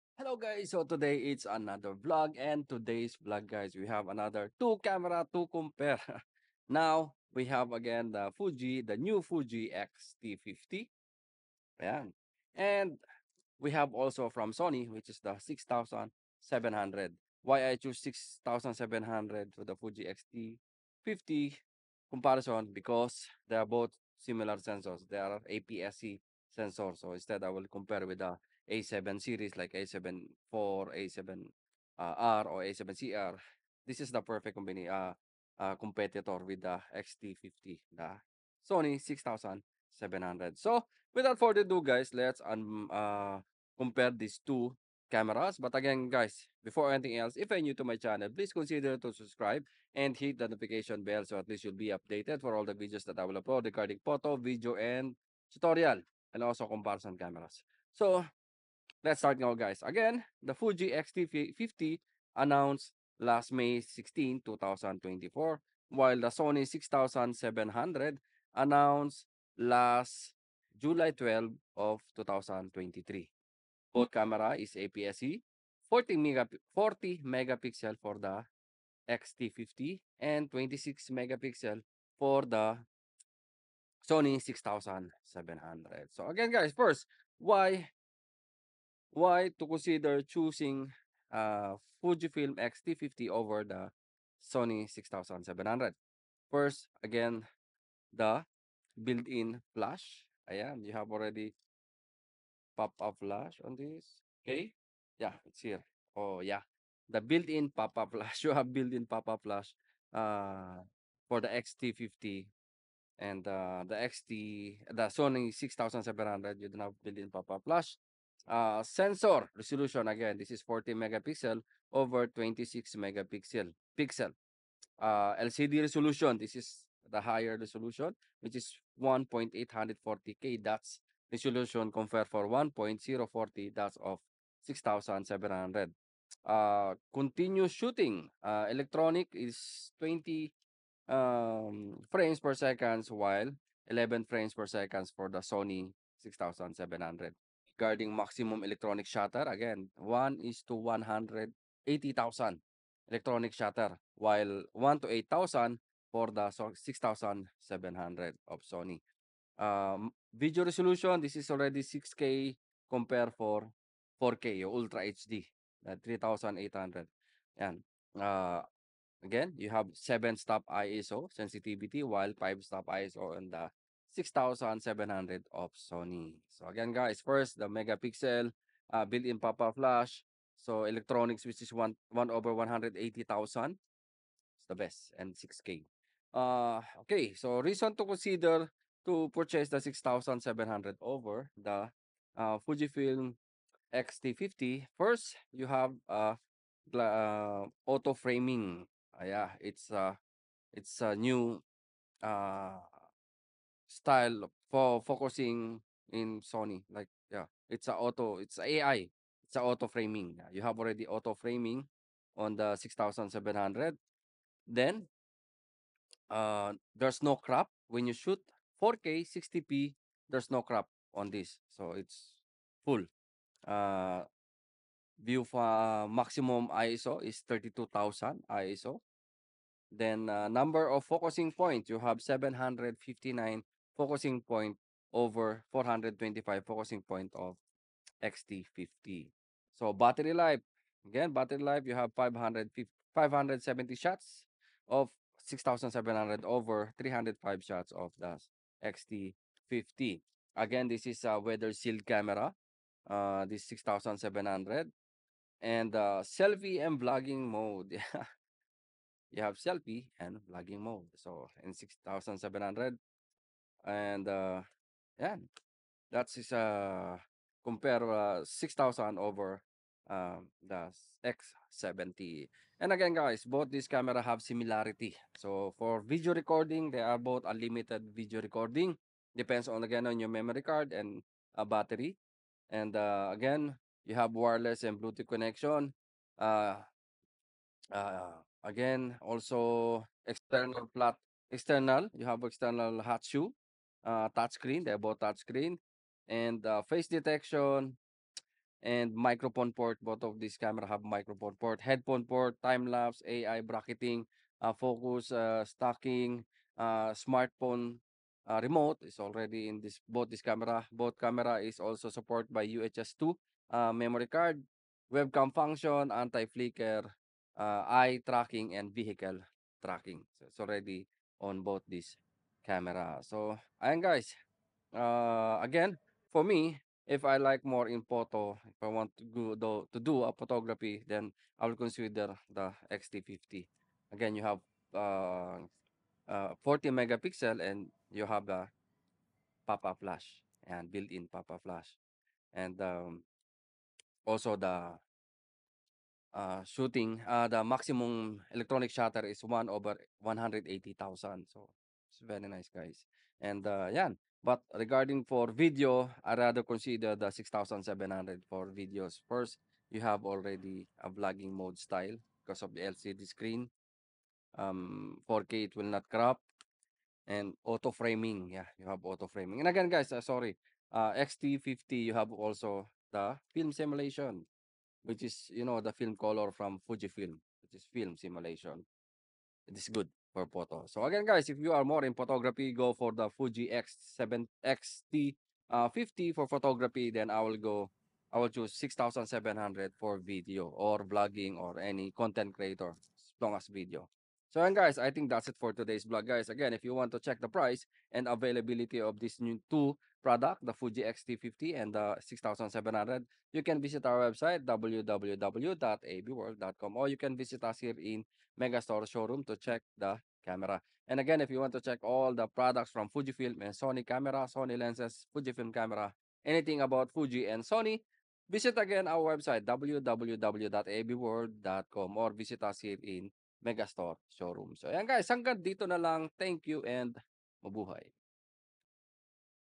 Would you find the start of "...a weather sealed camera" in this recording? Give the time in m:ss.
4:11.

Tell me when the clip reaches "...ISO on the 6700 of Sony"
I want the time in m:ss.
2:52.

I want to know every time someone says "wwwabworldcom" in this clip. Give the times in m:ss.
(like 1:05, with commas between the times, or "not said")
6:44, 6:59.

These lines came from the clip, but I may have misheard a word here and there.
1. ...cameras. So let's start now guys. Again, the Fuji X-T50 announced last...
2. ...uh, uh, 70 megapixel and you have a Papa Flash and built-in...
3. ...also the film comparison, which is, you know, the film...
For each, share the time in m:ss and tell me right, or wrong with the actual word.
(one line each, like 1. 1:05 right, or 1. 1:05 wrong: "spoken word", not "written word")
1. 0:57 right
2. 5:34 wrong: "40", not "70"
3. 6:12 wrong: "simulation", not "comparison".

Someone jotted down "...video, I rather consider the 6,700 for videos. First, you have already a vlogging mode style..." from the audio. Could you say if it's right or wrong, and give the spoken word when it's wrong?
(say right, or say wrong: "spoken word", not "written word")
right.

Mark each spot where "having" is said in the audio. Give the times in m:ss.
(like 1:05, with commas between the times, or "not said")
not said.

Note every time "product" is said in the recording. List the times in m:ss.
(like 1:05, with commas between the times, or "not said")
6:40, 6:52.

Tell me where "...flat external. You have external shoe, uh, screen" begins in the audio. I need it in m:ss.
4:50.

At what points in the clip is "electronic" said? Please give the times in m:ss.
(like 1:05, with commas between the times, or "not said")
2:18, 2:28, 2:33, 3:00, 5:48.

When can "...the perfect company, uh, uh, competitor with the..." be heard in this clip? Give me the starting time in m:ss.
0:34.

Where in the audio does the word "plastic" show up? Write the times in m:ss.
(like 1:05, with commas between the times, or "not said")
not said.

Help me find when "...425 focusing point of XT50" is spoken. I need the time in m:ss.
3:55.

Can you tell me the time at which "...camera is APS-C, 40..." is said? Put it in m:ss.
1:14.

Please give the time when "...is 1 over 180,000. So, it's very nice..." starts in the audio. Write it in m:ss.
5:49.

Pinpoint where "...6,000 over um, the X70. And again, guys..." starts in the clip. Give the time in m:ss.
4:28.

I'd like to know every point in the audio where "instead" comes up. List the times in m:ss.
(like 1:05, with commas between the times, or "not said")
0:27.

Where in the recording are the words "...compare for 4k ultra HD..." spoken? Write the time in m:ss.
2:42.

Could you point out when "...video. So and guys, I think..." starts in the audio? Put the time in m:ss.
6:33.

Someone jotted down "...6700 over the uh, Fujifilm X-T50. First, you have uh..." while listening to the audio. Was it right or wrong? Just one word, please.
right.